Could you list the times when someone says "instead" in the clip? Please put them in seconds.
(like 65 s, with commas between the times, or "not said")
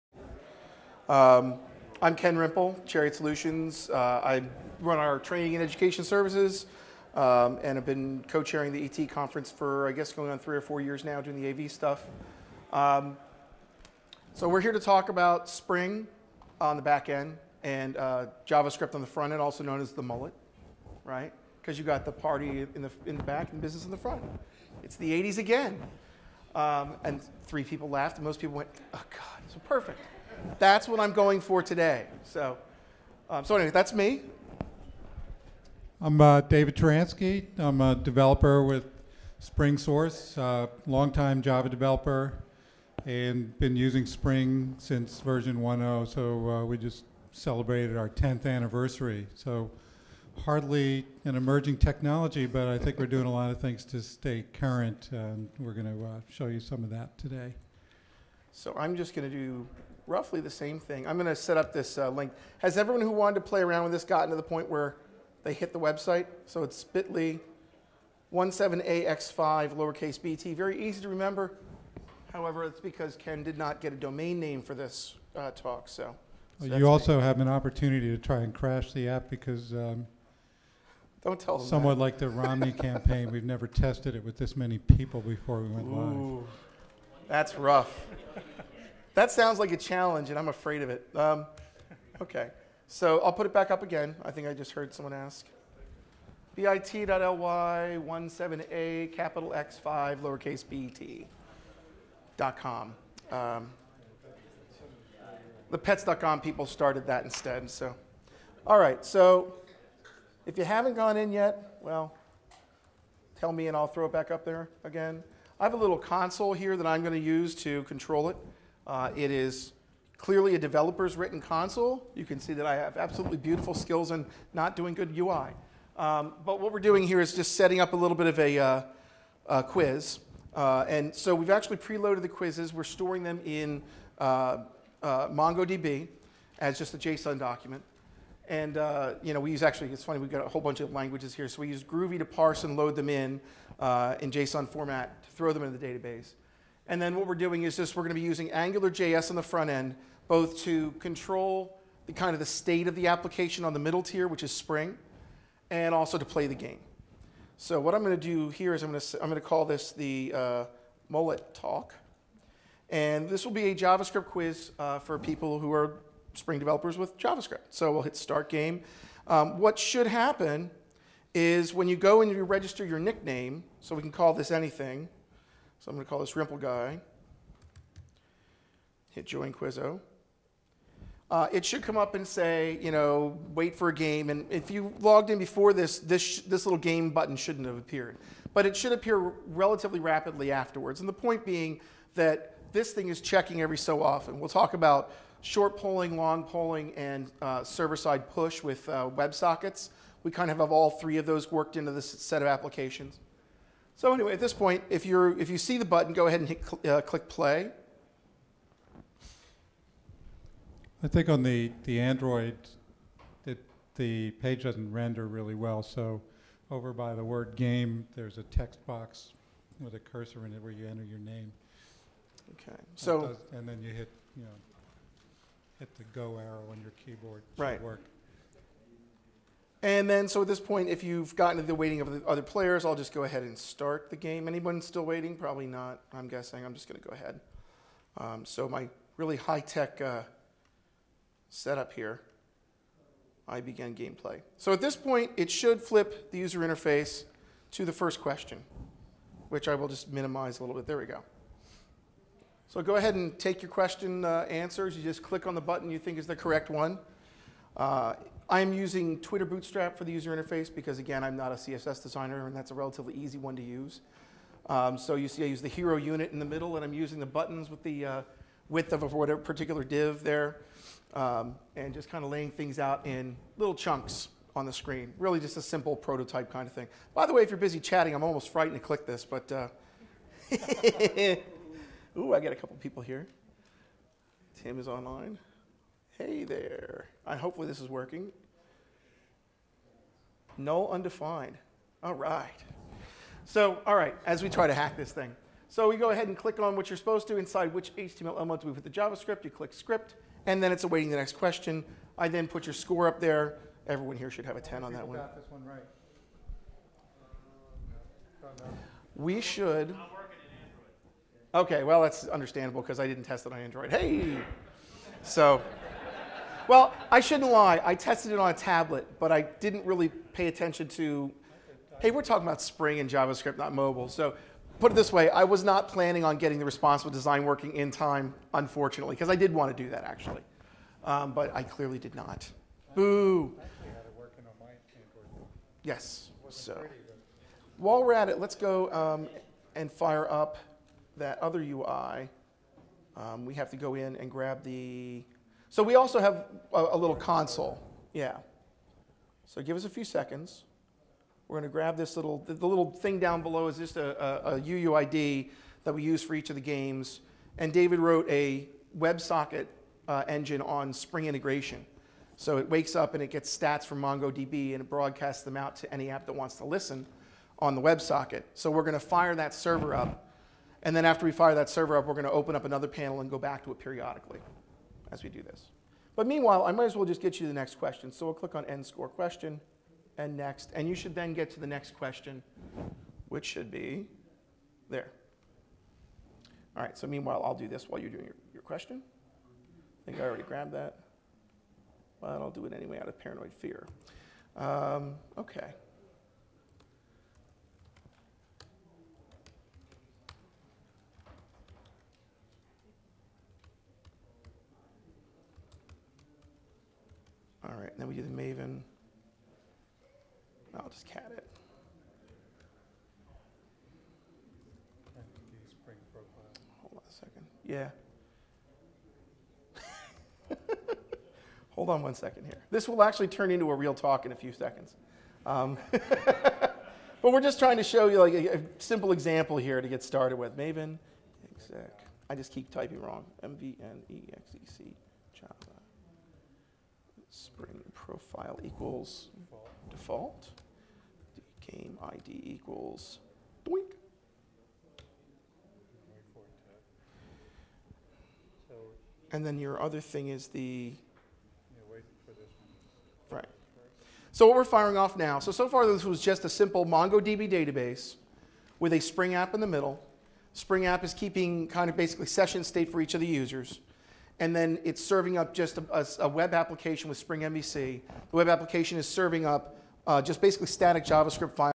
107 s.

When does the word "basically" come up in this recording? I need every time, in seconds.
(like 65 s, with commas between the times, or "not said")
461 s, 470 s.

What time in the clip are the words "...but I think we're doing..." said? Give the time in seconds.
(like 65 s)
52 s.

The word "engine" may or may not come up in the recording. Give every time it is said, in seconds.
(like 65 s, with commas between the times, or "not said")
360 s.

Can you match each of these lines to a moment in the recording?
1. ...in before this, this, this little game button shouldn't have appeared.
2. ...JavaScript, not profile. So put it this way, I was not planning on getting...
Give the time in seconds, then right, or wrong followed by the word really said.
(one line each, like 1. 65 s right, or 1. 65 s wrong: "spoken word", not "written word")
1. 185 s right
2. 323 s wrong: "mobile", not "profile".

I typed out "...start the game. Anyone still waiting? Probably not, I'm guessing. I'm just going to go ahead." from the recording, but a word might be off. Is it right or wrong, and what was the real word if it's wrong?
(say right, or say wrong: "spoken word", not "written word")
right.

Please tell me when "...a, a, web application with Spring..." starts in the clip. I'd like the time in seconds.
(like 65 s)
465 s.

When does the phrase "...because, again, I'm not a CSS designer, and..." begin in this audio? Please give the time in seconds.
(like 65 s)
260 s.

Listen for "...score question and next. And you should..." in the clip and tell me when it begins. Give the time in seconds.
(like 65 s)
378 s.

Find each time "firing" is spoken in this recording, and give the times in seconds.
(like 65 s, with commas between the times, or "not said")
454 s.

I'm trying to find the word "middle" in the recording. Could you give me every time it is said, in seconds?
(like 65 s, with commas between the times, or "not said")
153 s, 266 s, 459 s.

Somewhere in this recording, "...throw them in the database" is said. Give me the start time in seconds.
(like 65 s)
145 s.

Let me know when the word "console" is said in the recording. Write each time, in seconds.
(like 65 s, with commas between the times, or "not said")
115 s, 121 s, 347 s.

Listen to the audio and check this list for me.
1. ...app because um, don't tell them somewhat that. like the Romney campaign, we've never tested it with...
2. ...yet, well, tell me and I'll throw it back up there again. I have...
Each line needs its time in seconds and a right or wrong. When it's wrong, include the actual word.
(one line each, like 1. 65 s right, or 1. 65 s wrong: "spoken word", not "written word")
1. 79 s right
2. 111 s right.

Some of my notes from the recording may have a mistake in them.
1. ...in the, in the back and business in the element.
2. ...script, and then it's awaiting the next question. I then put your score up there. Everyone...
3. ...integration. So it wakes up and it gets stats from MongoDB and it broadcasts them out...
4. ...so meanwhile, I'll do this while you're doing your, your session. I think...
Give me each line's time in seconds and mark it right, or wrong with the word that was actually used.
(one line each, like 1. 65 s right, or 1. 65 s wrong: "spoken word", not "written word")
1. 22 s wrong: "front", not "element"
2. 299 s right
3. 361 s right
4. 386 s wrong: "question", not "session".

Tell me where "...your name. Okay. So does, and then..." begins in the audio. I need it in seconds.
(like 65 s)
221 s.